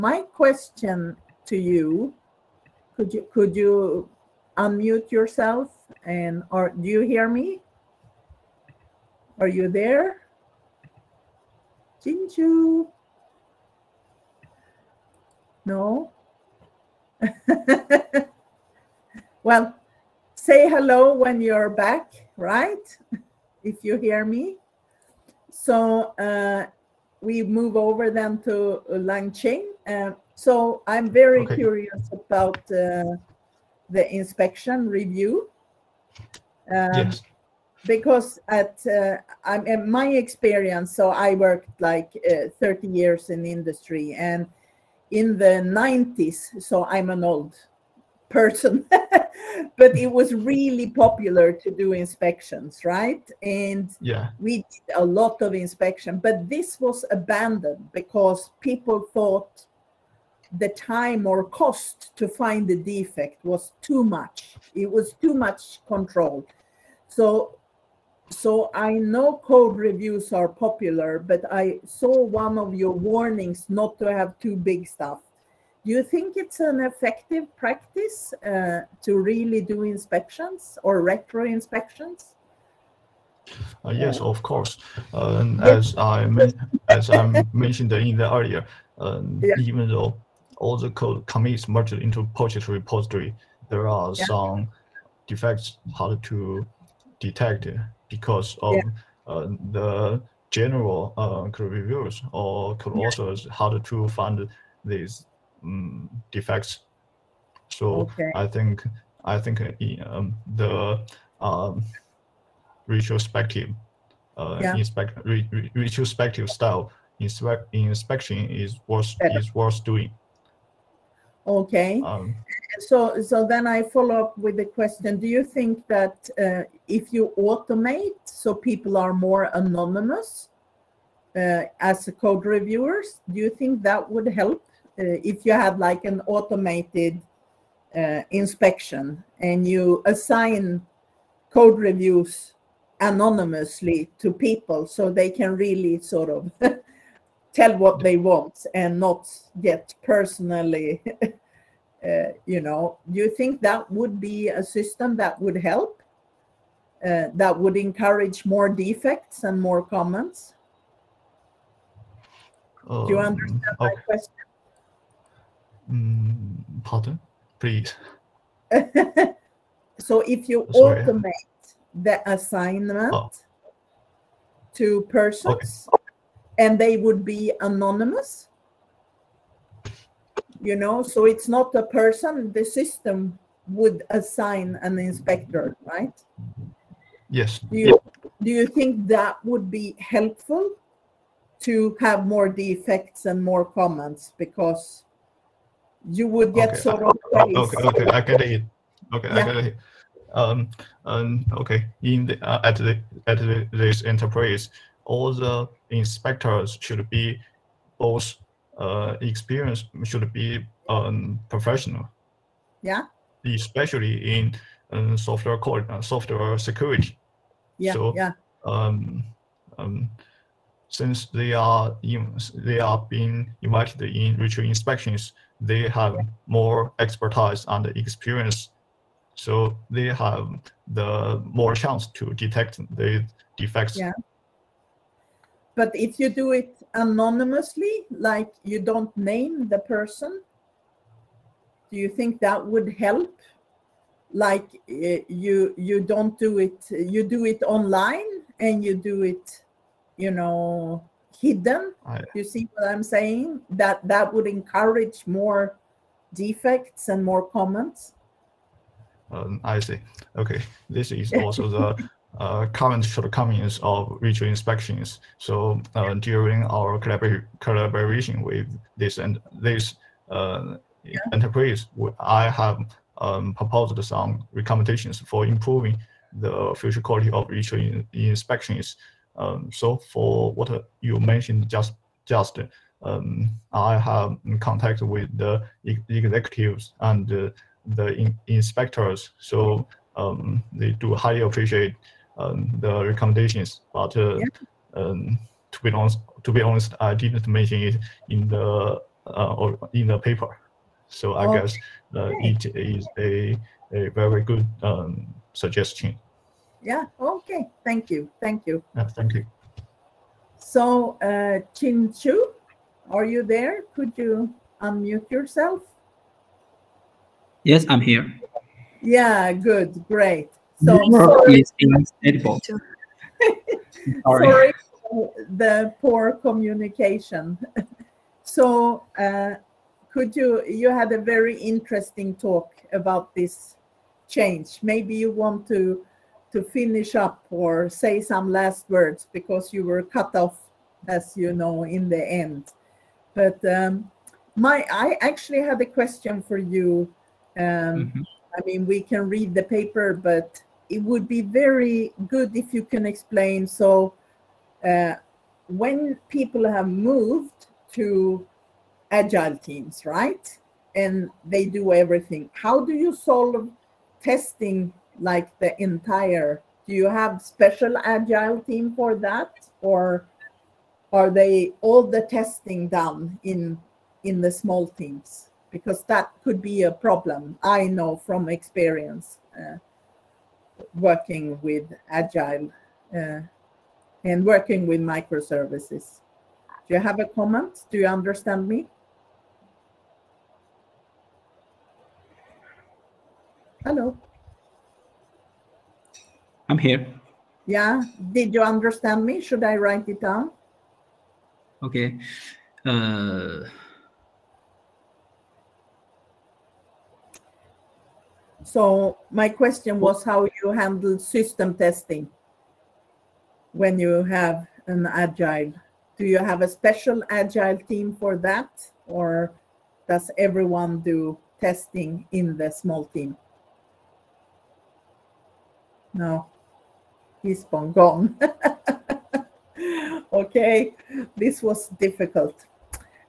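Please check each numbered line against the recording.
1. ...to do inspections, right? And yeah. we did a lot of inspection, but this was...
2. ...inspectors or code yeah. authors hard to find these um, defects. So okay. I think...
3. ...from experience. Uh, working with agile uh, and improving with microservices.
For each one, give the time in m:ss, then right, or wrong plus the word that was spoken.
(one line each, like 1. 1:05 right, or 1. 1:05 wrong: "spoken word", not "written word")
1. 0:51 right
2. 1:41 wrong: "reviewers", not "inspectors"
3. 6:18 wrong: "working", not "improving".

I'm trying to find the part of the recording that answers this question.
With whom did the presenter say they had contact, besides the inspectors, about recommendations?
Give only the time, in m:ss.
4:45.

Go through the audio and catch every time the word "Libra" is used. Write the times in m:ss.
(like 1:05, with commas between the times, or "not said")
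not said.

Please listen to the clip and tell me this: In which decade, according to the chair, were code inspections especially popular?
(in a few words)
the 90s.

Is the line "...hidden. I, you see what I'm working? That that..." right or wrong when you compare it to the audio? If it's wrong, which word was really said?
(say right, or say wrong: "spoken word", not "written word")
wrong: "saying", not "working".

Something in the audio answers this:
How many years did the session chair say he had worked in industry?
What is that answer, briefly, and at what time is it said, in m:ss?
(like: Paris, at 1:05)
30, at 0:42.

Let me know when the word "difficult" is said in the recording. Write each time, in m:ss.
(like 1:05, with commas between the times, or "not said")
7:11.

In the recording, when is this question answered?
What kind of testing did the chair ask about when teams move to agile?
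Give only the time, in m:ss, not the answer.
6:51.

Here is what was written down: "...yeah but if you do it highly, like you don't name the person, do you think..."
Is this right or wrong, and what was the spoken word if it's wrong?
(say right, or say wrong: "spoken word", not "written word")
wrong: "anonymously", not "highly".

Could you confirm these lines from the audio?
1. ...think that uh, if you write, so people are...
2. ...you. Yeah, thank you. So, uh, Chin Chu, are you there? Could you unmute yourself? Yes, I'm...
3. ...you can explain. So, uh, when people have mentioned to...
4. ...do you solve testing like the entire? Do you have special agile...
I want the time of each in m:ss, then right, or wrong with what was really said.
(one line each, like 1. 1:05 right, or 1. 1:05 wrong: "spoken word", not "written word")
1. 2:05 wrong: "automate", not "write"
2. 5:08 right
3. 5:52 wrong: "moved", not "mentioned"
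4. 6:02 right.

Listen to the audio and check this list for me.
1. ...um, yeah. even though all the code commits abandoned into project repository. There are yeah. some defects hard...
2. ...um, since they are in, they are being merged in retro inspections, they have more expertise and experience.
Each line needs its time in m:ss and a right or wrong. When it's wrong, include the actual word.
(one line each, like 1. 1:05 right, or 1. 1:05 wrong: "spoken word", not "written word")
1. 1:28 wrong: "merged", not "abandoned"
2. 3:39 wrong: "invited", not "merged".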